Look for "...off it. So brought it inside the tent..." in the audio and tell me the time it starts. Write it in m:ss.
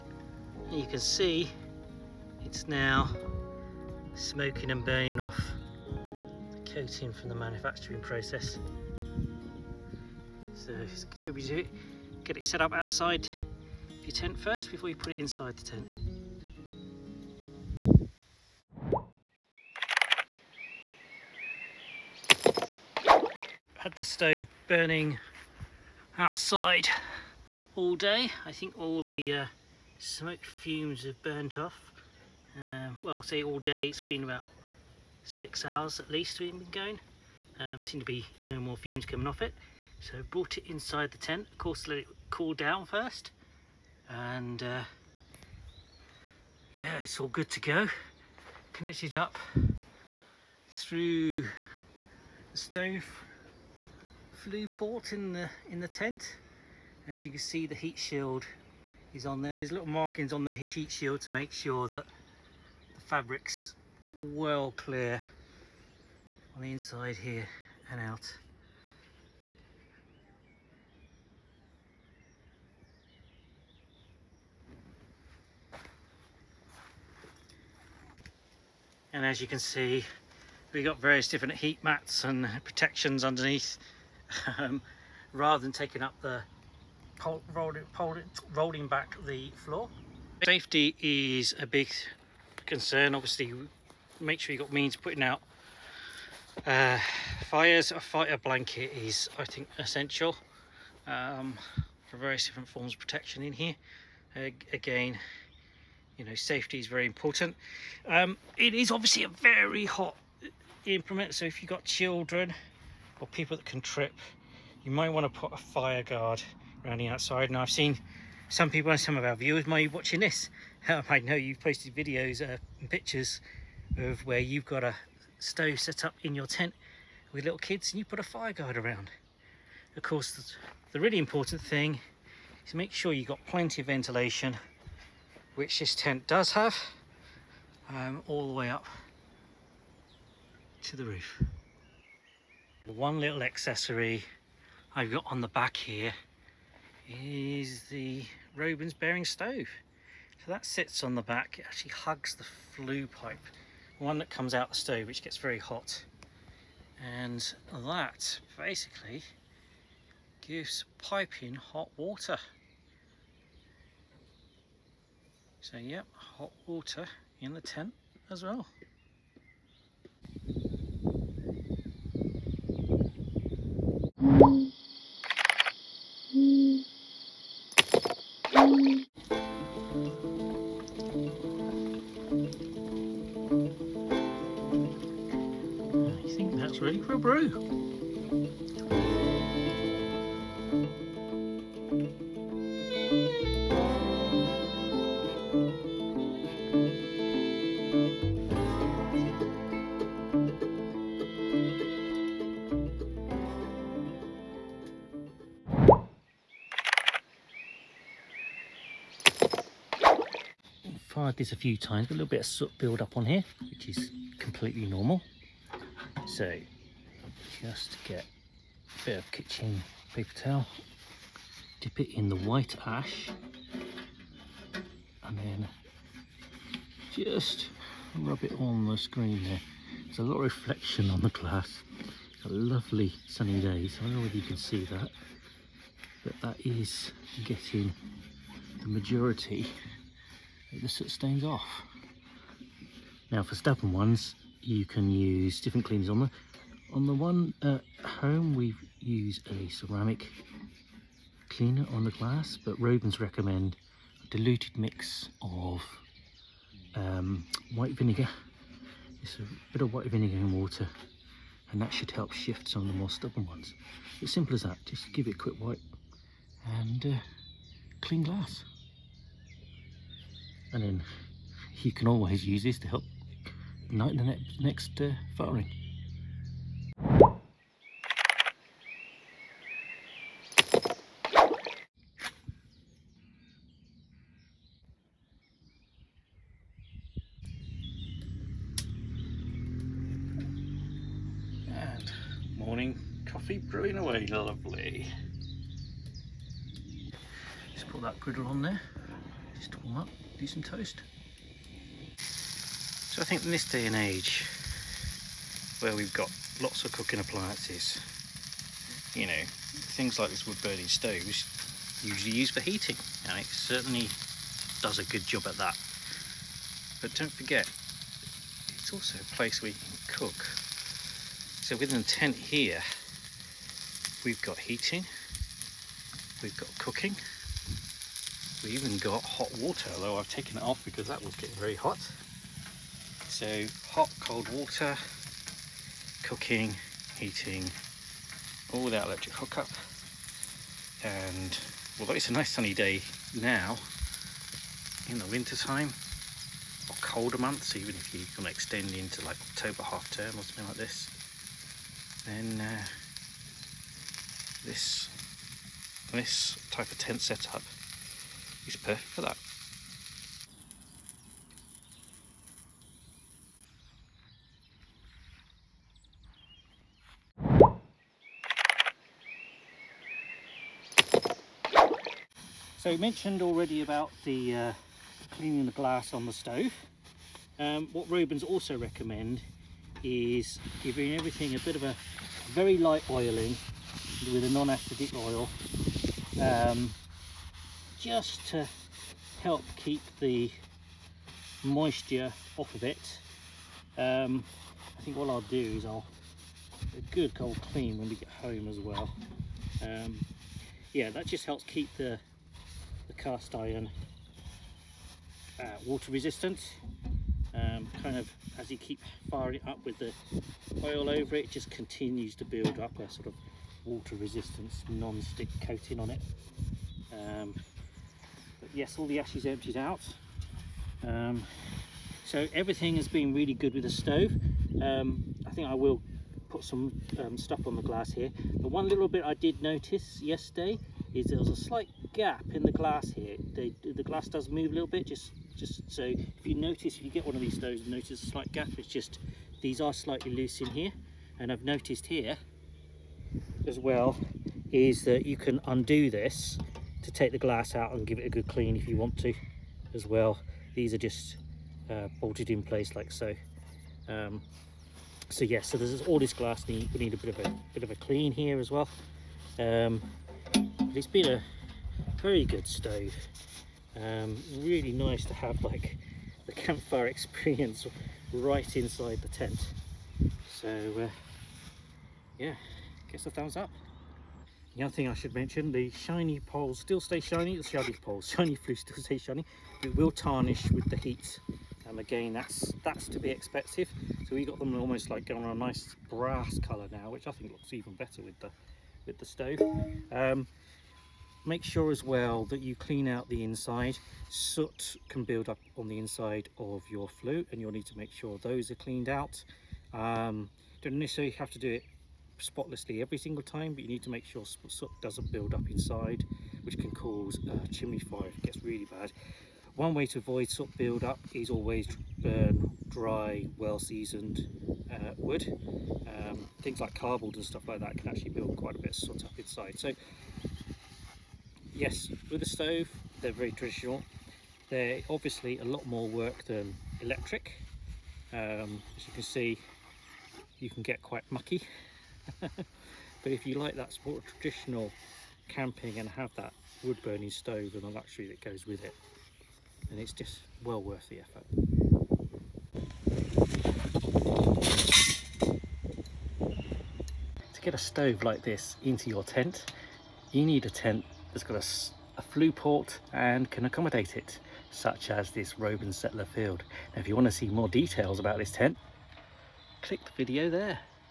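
0:39.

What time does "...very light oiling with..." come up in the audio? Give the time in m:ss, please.
6:22.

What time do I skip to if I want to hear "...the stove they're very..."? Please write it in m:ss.
8:42.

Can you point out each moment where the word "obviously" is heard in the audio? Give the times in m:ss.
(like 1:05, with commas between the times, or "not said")
1:33, 1:48, 8:45.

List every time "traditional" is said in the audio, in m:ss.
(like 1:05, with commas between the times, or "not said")
8:43, 8:54.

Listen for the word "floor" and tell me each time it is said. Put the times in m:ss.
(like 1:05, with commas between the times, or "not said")
1:29.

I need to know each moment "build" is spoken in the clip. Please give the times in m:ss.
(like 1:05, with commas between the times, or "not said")
3:32, 6:52, 8:15, 8:25, 8:30, 8:38.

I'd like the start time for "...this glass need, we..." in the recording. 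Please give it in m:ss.
7:36.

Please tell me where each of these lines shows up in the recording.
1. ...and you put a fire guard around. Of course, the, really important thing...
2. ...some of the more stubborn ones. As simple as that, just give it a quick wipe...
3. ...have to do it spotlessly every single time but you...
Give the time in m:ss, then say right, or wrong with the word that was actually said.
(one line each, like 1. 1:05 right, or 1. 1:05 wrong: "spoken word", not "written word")
1. 2:07 right
2. 4:22 right
3. 8:21 right.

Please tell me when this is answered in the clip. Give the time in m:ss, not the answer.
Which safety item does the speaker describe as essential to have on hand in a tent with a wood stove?
1:37.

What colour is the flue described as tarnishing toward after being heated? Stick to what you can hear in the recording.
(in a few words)
Brass.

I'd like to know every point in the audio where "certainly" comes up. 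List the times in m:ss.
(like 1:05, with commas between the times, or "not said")
5:13.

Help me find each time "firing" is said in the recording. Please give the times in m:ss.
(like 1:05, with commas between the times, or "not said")
4:35, 6:49.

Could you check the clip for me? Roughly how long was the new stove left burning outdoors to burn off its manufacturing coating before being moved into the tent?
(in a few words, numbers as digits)
6 hours.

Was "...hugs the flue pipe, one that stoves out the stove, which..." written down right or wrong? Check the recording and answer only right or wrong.
wrong.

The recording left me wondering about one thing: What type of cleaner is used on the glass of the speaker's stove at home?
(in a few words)
Ceramic cleaner.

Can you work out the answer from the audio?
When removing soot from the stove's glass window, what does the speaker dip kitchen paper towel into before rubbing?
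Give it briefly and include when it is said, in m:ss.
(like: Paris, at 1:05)
White ash, at 3:42.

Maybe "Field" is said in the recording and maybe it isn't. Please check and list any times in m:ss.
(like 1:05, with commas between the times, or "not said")
9:16.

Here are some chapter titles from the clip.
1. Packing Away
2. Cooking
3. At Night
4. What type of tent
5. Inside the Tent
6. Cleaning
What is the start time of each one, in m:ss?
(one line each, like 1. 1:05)
1. 6:06
2. 4:37
3. 2:54
4. 9:07
5. 0:19
6. 3:26.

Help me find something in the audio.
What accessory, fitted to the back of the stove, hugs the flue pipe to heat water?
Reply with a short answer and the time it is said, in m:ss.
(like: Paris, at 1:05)
Robens bearing stove, at 2:28.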